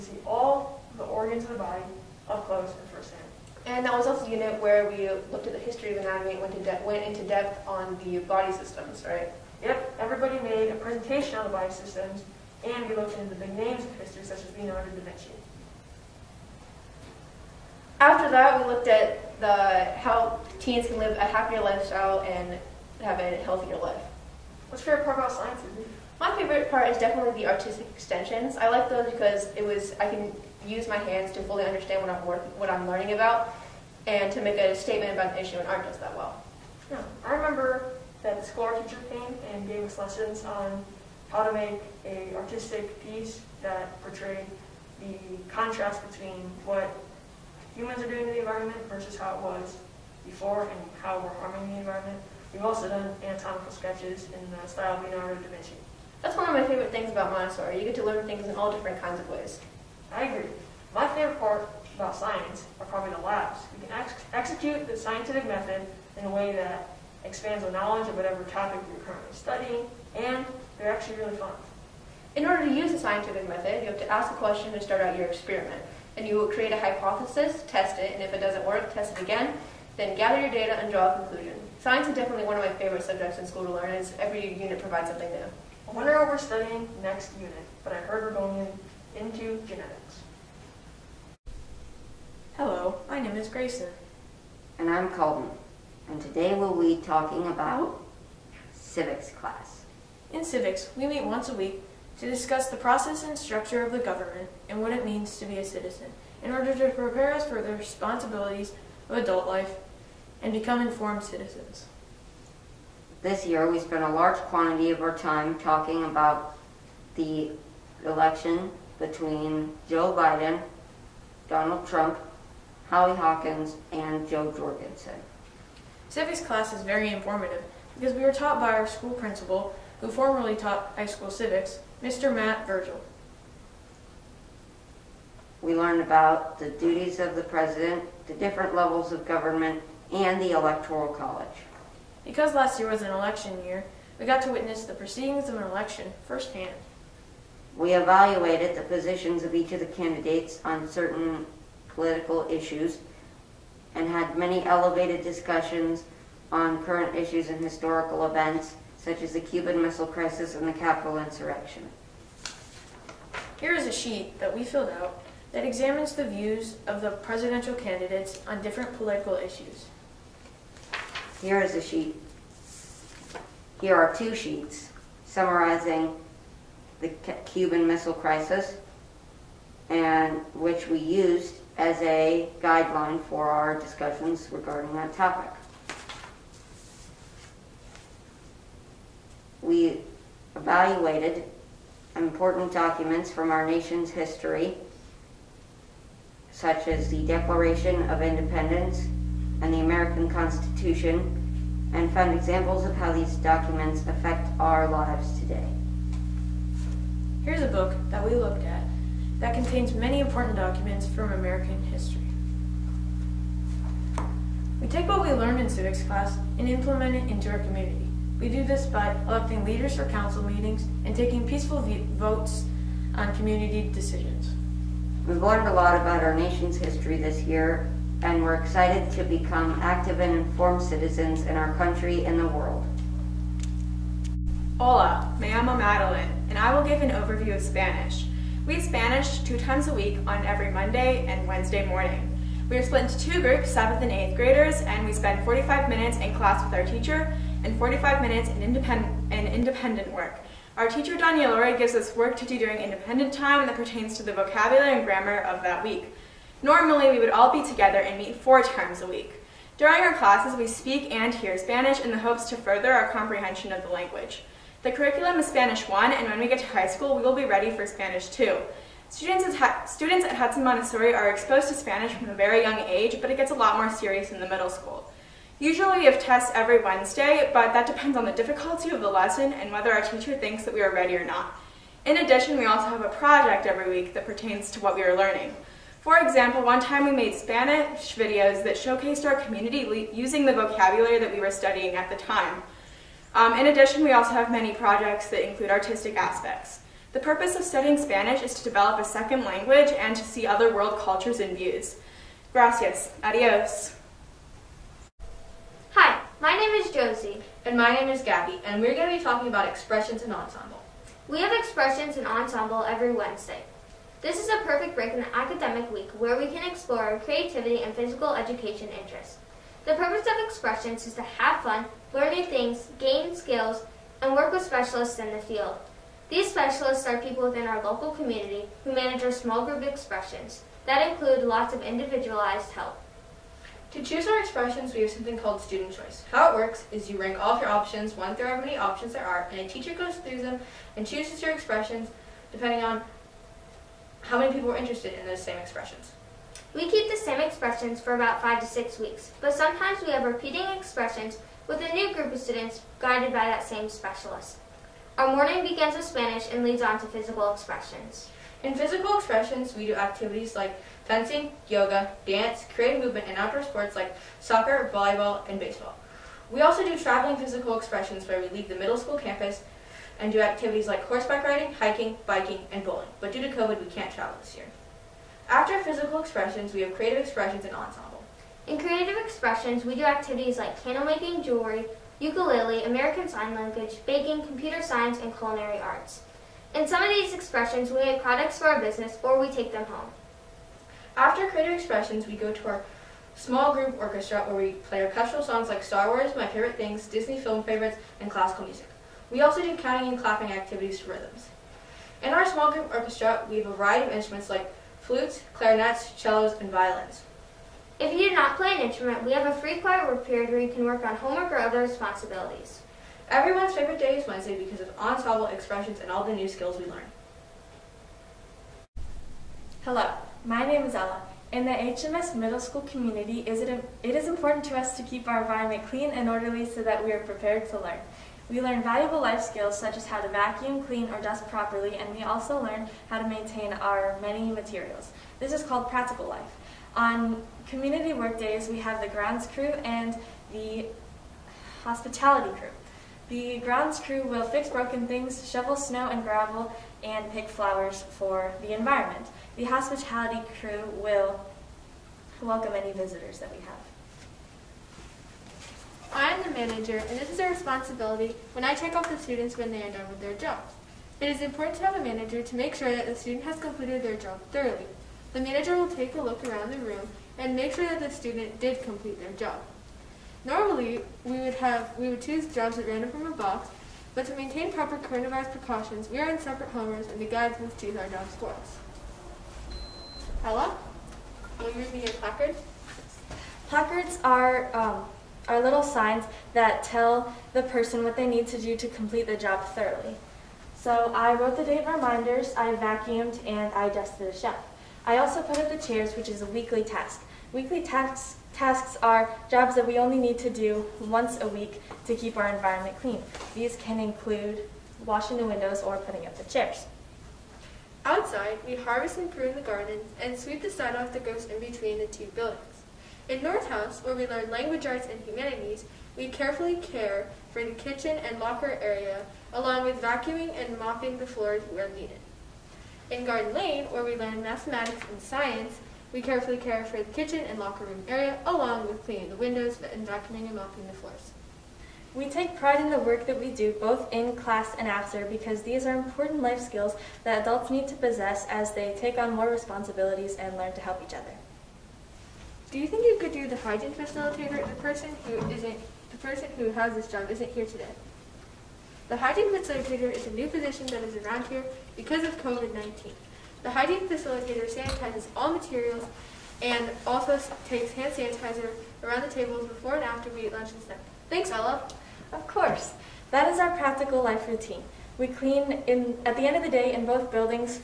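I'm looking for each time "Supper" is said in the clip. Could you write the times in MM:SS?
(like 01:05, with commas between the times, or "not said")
not said.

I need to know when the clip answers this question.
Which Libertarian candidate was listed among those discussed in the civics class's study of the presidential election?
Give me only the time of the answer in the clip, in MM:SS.
02:04.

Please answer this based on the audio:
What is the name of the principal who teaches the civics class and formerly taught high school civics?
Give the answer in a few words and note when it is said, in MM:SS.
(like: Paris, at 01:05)
Matt Virgil, at 02:12.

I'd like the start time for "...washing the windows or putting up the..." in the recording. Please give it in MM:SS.
08:25.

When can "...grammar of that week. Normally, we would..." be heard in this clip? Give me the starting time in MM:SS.
04:15.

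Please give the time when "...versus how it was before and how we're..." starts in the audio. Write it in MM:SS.
00:48.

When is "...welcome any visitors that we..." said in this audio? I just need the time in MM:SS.
07:32.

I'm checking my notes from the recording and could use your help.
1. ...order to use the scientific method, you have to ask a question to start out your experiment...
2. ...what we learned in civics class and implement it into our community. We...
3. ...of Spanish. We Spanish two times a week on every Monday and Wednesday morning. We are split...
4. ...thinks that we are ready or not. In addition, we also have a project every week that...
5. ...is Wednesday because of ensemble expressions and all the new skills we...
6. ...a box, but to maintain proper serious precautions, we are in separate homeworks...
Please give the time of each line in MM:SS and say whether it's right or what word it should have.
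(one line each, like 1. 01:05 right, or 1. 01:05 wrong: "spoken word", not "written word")
1. 01:12 right
2. 03:35 right
3. 03:57 right
4. 04:40 right
5. 06:54 right
6. 07:53 wrong: "coronavirus", not "serious".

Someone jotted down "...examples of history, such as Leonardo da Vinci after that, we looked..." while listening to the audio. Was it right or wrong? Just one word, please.
wrong.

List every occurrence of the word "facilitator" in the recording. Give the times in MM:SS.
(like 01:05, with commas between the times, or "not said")
09:03, 09:09, 09:14.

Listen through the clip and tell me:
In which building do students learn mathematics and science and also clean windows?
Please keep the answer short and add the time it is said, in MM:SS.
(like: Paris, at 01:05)
Garden Lane, at 08:43.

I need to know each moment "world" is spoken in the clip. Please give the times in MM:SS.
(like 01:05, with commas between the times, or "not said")
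03:52, 05:00.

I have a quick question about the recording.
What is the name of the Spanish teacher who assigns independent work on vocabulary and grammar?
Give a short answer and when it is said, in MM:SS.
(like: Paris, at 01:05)
Doña Lori, at 04:11.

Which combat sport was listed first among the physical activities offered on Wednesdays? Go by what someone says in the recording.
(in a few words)
fencing.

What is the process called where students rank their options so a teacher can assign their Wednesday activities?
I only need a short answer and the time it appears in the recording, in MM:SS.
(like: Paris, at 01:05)
student choice, at 05:35.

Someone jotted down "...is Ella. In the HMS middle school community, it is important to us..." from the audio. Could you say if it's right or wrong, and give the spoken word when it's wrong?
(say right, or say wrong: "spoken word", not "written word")
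right.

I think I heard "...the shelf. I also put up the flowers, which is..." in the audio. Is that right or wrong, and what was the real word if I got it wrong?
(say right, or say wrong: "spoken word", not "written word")
wrong: "chairs", not "flowers".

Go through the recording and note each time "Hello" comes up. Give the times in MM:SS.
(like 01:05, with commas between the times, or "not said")
01:32, 06:59.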